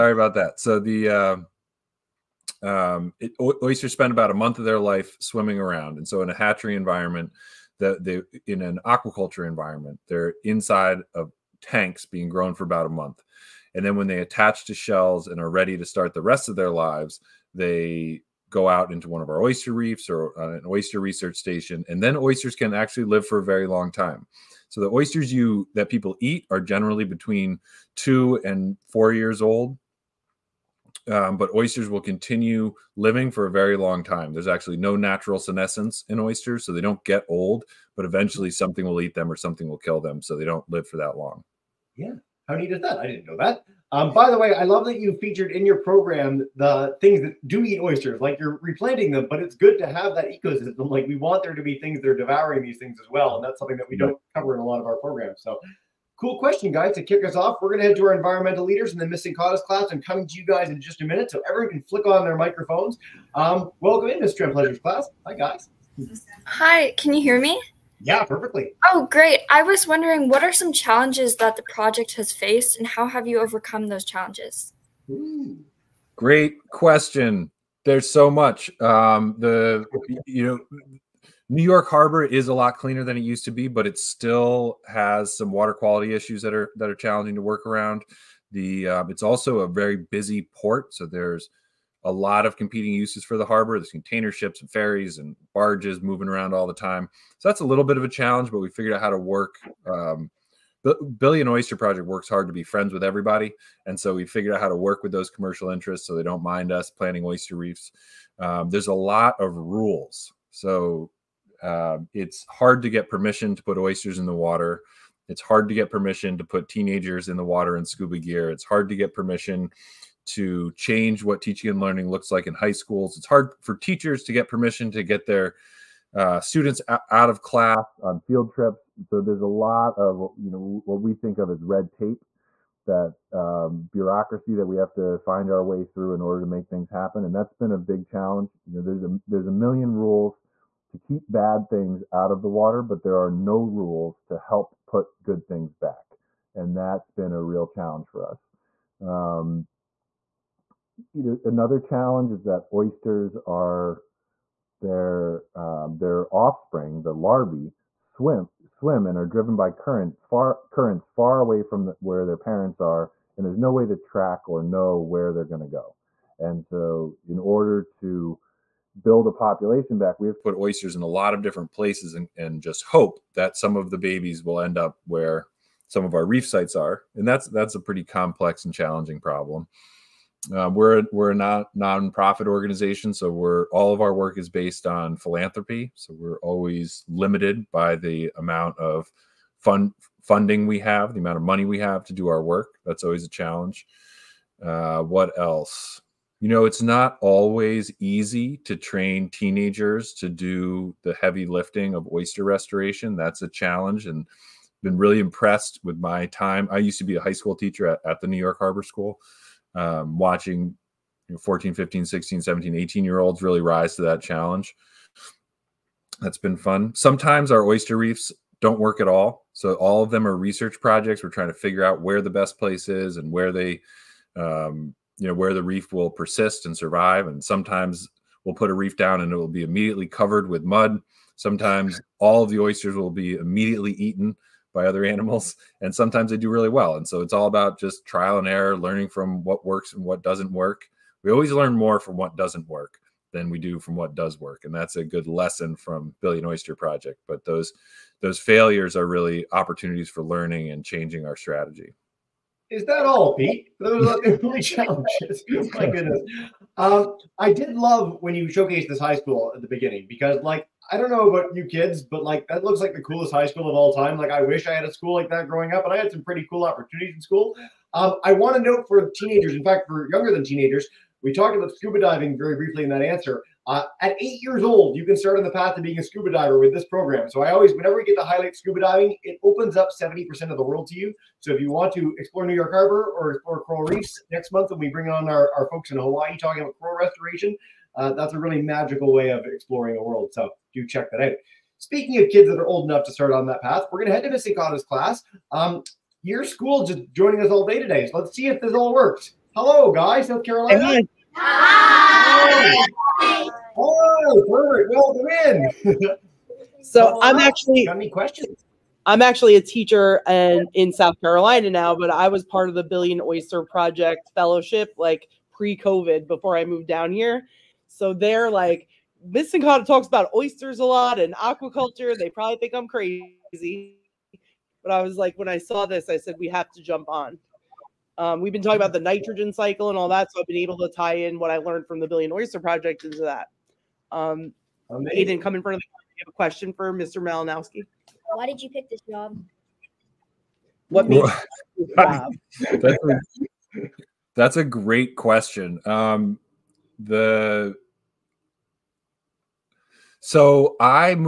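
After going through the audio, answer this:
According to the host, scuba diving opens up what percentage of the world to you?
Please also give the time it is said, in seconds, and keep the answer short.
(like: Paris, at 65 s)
70%, at 279 s.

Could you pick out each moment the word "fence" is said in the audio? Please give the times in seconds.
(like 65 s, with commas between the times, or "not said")
not said.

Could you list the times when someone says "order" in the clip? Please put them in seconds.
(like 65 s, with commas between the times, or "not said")
136 s, 167 s.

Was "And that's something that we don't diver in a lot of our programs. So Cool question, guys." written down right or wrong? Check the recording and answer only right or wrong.
wrong.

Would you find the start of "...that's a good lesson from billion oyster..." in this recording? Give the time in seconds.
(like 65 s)
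244 s.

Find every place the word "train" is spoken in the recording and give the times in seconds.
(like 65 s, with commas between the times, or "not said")
198 s.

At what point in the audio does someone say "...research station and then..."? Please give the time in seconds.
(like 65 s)
20 s.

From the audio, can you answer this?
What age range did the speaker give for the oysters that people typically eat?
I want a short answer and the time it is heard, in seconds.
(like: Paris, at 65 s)
2 to 4 years old, at 27 s.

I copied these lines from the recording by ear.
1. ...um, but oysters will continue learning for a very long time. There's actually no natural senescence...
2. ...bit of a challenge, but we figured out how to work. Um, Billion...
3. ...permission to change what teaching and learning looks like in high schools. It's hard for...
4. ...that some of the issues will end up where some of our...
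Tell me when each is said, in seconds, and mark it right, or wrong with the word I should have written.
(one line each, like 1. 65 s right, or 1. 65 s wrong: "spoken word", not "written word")
1. 31 s wrong: "living", not "learning"
2. 97 s right
3. 119 s right
4. 173 s wrong: "babies", not "issues".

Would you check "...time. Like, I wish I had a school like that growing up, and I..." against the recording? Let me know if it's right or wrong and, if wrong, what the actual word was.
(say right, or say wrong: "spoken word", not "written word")
right.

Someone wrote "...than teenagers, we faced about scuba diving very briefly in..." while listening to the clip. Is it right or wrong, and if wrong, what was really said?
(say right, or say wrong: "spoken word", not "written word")
wrong: "talked", not "faced".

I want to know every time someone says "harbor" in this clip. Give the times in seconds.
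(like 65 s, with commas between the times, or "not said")
81 s, 93 s, 208 s, 282 s.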